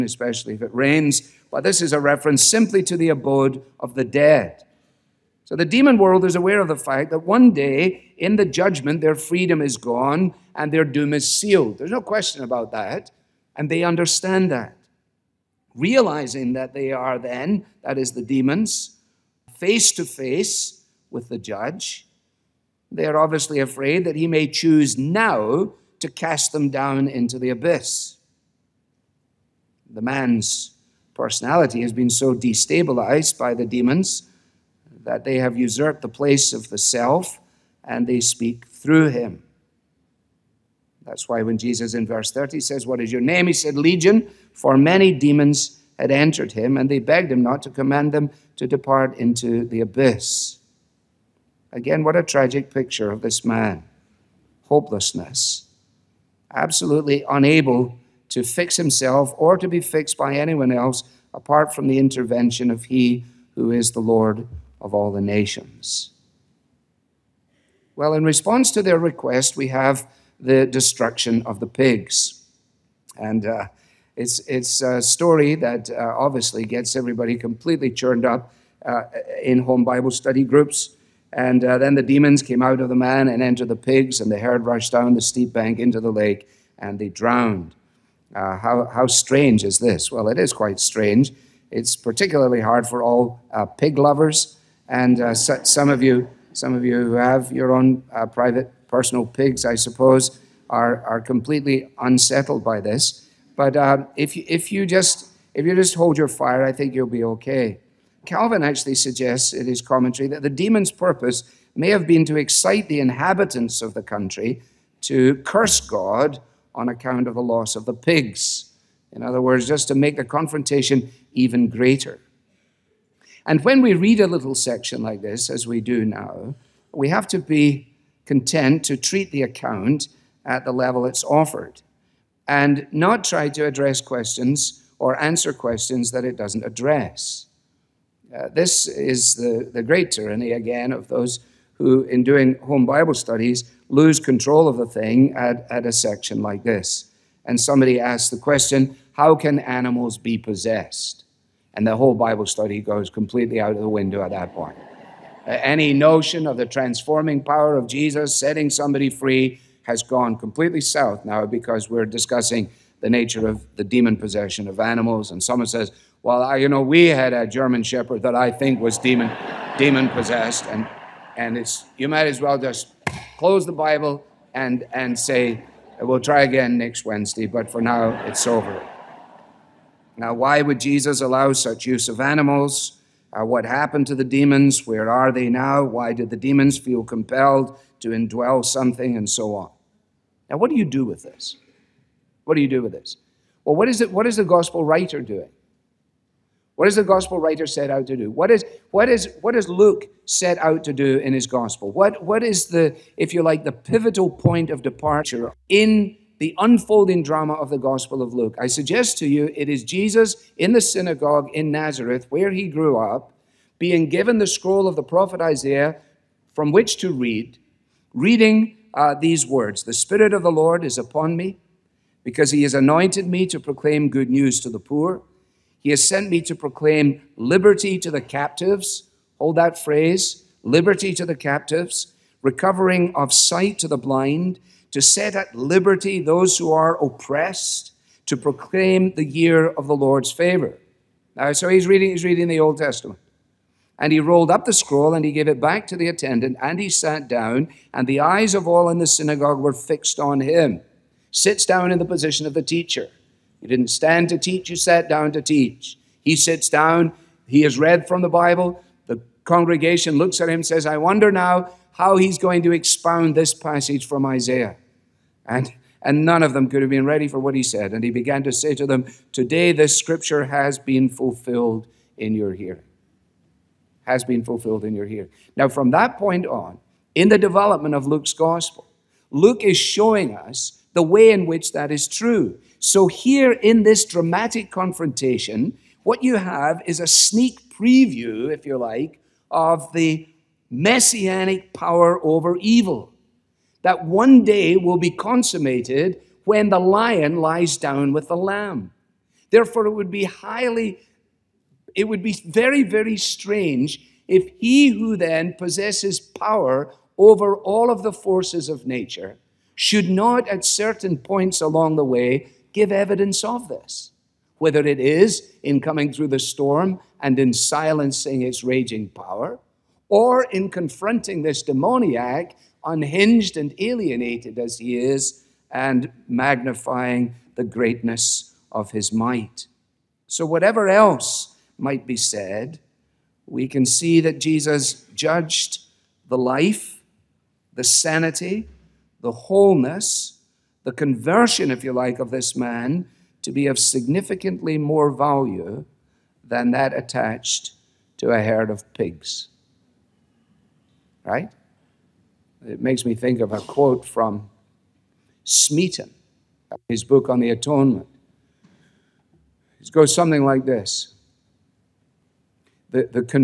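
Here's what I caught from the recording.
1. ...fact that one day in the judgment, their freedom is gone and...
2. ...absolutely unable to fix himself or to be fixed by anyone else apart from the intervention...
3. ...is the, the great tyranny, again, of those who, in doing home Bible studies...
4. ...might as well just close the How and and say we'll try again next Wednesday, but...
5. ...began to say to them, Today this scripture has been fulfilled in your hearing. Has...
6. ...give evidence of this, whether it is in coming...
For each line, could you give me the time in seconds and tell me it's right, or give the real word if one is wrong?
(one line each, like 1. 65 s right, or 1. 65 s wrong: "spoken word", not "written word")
1. 6 s right
2. 56 s right
3. 138 s right
4. 172 s wrong: "Bible", not "How"
5. 268 s right
6. 312 s right.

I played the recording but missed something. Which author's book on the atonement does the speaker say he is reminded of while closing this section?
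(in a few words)
Smeaton.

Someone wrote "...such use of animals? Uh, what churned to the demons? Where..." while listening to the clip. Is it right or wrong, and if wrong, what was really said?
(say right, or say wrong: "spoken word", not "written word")
wrong: "happened", not "churned".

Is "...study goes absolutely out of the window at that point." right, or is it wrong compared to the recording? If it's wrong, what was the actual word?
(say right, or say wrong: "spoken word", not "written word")
wrong: "completely", not "absolutely".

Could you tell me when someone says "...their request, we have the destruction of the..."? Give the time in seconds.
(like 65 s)
68 s.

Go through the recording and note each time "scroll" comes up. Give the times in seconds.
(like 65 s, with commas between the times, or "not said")
214 s, 244 s.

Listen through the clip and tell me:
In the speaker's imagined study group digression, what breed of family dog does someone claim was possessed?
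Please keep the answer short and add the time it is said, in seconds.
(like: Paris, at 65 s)
German Shepherd, at 167 s.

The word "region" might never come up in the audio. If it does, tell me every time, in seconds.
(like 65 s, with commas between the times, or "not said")
not said.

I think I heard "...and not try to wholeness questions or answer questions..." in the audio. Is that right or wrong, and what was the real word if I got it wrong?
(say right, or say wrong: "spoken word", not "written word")
wrong: "address", not "wholeness".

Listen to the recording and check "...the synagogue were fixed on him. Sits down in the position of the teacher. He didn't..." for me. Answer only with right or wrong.
right.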